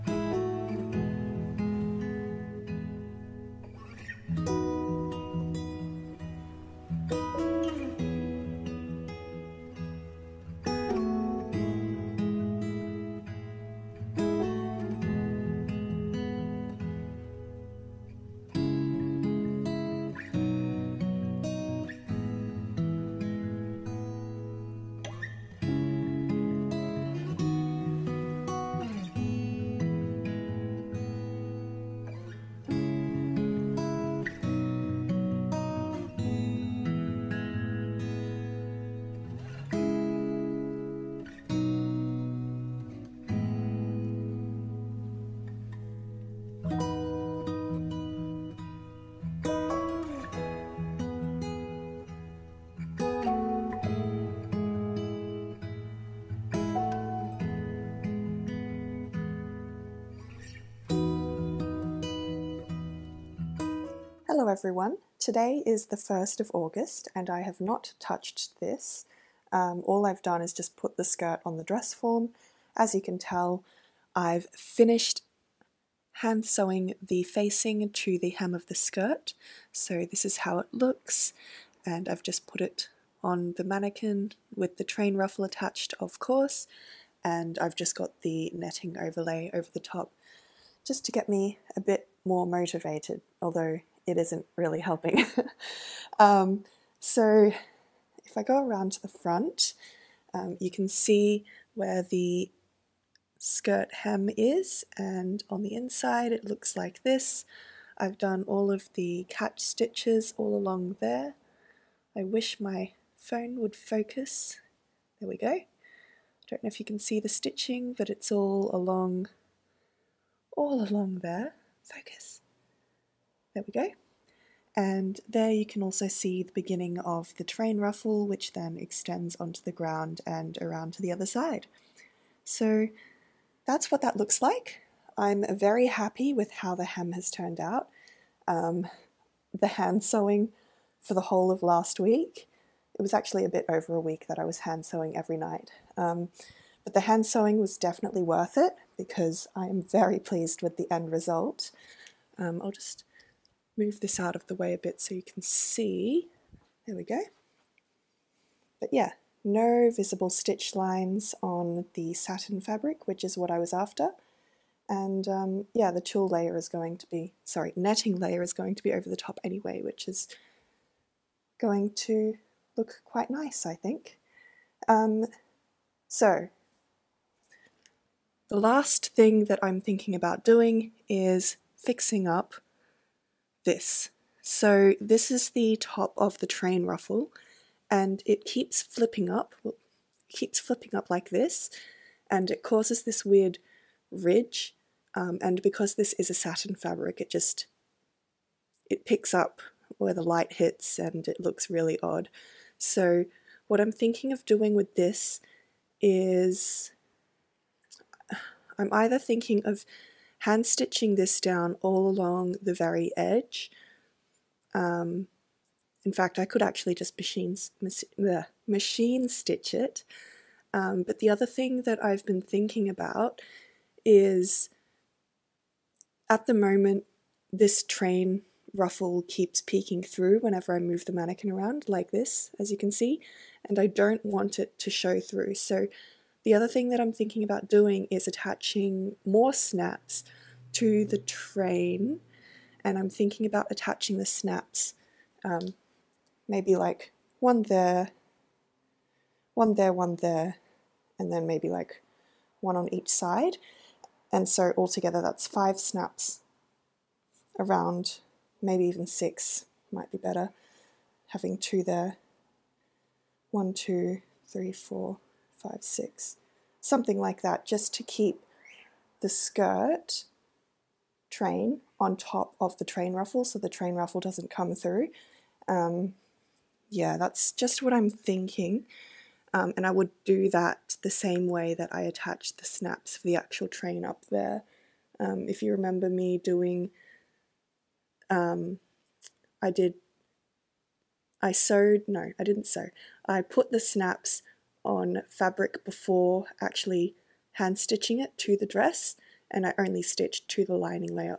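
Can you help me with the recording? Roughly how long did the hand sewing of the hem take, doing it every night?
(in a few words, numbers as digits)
a bit over a week.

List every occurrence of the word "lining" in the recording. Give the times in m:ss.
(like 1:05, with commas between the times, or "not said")
5:00.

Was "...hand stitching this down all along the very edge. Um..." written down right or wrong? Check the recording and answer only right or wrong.
right.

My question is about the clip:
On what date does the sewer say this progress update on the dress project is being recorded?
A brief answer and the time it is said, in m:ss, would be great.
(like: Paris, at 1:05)
1st of August, at 1:05.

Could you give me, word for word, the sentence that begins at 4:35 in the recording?
Um, yeah, that's just what I'm thinking.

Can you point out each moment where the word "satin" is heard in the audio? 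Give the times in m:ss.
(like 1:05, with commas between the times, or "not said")
2:42, 3:16.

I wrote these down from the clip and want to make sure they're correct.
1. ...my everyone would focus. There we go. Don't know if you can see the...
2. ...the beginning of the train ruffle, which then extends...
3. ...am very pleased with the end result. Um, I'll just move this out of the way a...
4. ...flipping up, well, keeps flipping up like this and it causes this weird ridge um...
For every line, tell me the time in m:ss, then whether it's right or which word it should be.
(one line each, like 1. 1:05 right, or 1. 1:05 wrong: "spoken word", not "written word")
1. 1:52 wrong: "phone", not "everyone"
2. 2:06 right
3. 2:29 right
4. 3:08 right.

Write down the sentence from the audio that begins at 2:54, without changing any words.
Um, so, the last thing that I'm thinking about doing is fixing up this.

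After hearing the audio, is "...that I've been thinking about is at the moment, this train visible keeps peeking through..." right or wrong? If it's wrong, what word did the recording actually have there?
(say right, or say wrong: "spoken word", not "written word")
wrong: "ruffle", not "visible".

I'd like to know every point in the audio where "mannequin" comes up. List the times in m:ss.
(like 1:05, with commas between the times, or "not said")
1:23, 3:51.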